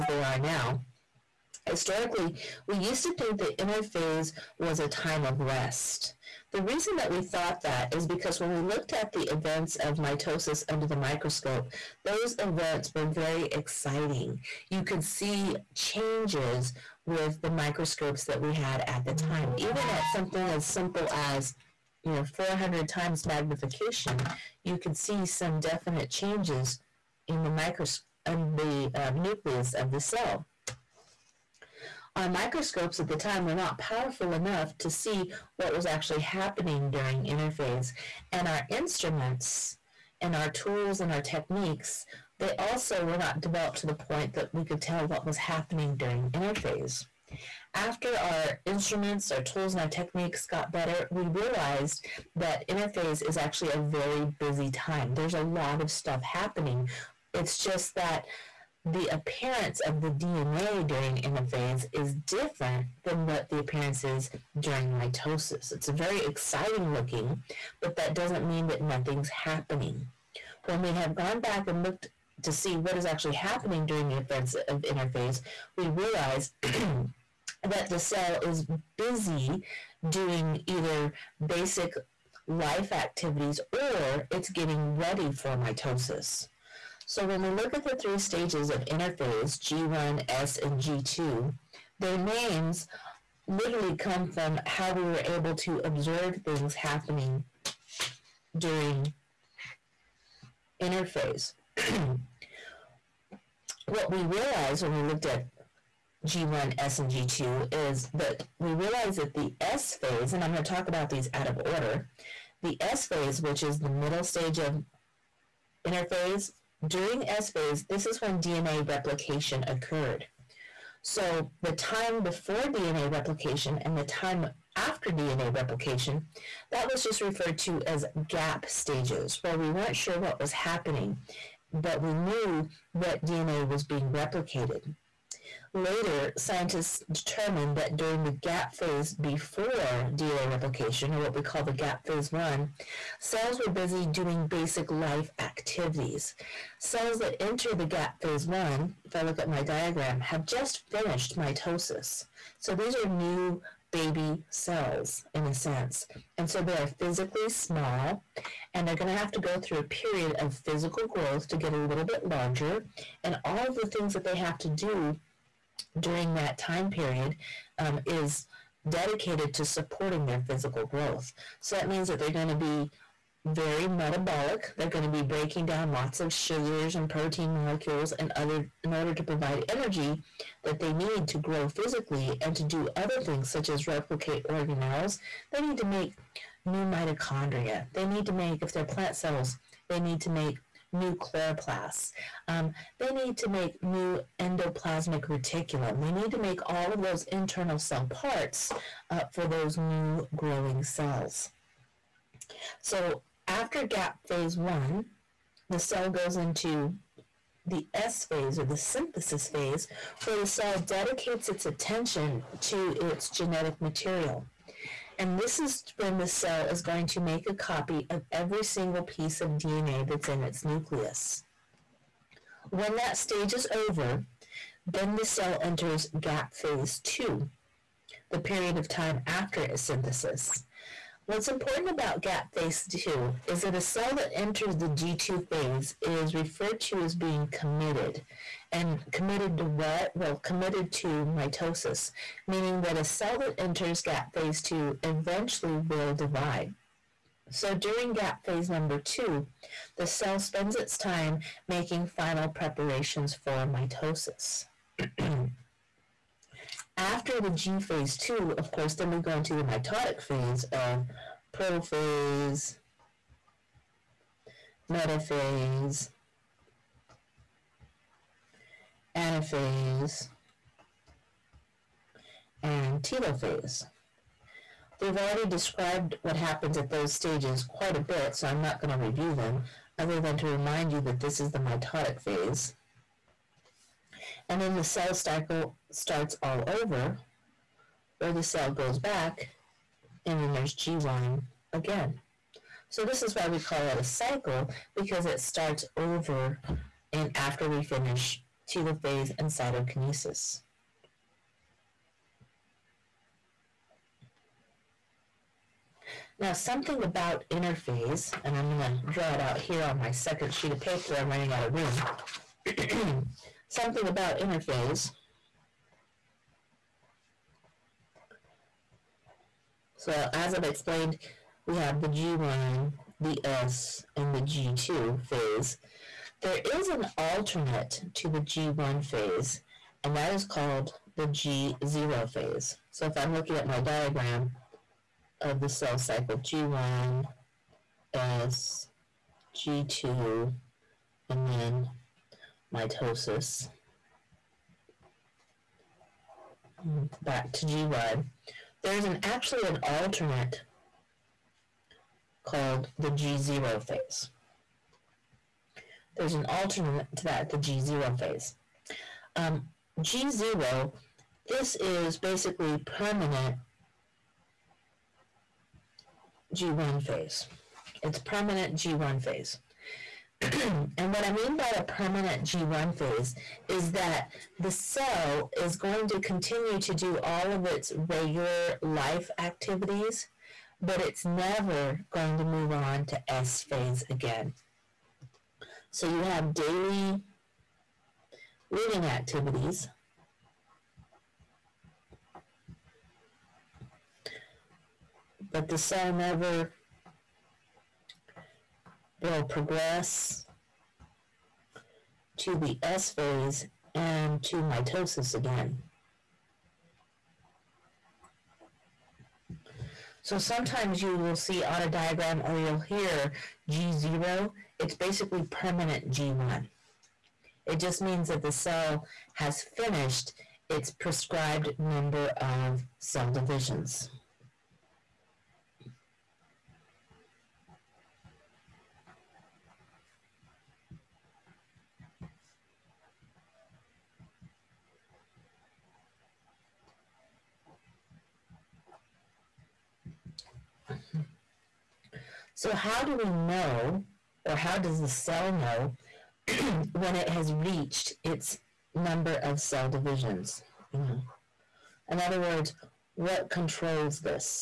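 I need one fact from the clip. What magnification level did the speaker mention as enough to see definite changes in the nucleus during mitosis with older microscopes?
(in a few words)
400 times.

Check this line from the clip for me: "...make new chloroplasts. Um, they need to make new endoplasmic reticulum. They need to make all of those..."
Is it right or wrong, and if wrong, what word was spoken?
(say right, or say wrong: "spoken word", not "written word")
right.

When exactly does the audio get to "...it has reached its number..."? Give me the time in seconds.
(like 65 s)
447 s.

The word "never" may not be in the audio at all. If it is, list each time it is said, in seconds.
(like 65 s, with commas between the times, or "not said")
381 s, 396 s.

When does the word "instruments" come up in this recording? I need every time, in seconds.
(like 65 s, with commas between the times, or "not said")
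38 s, 48 s.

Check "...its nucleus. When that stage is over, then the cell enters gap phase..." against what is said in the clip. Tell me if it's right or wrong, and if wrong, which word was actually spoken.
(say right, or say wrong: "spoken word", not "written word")
right.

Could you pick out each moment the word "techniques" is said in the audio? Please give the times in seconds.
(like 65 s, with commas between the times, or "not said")
41 s, 49 s.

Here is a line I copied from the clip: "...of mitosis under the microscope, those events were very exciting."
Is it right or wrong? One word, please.
right.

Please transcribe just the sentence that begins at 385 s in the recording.
So you have daily living activities.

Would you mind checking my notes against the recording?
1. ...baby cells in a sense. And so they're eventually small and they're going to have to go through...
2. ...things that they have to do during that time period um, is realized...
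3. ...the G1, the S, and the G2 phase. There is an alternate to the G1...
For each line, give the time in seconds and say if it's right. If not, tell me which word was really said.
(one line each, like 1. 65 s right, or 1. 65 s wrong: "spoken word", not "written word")
1. 153 s wrong: "physically", not "eventually"
2. 163 s wrong: "dedicated", not "realized"
3. 321 s right.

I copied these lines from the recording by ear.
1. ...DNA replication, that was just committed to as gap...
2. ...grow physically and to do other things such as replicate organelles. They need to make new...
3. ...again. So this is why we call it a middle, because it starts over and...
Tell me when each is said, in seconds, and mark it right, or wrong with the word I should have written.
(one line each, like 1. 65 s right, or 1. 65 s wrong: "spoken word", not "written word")
1. 125 s wrong: "referred", not "committed"
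2. 181 s right
3. 291 s wrong: "cycle", not "middle".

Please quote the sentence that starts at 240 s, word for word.
Well, committed to mitosis, meaning that a cell that enters gap phase two eventually will divide.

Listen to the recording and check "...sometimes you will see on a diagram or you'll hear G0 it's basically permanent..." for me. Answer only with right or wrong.
right.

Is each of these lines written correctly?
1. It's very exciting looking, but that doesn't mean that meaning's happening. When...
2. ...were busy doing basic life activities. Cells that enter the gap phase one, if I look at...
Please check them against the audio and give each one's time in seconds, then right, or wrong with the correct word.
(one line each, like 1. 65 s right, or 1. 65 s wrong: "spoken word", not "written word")
1. 65 s wrong: "nothing", not "meaning"
2. 143 s right.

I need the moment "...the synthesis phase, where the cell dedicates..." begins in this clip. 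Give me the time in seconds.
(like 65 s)
208 s.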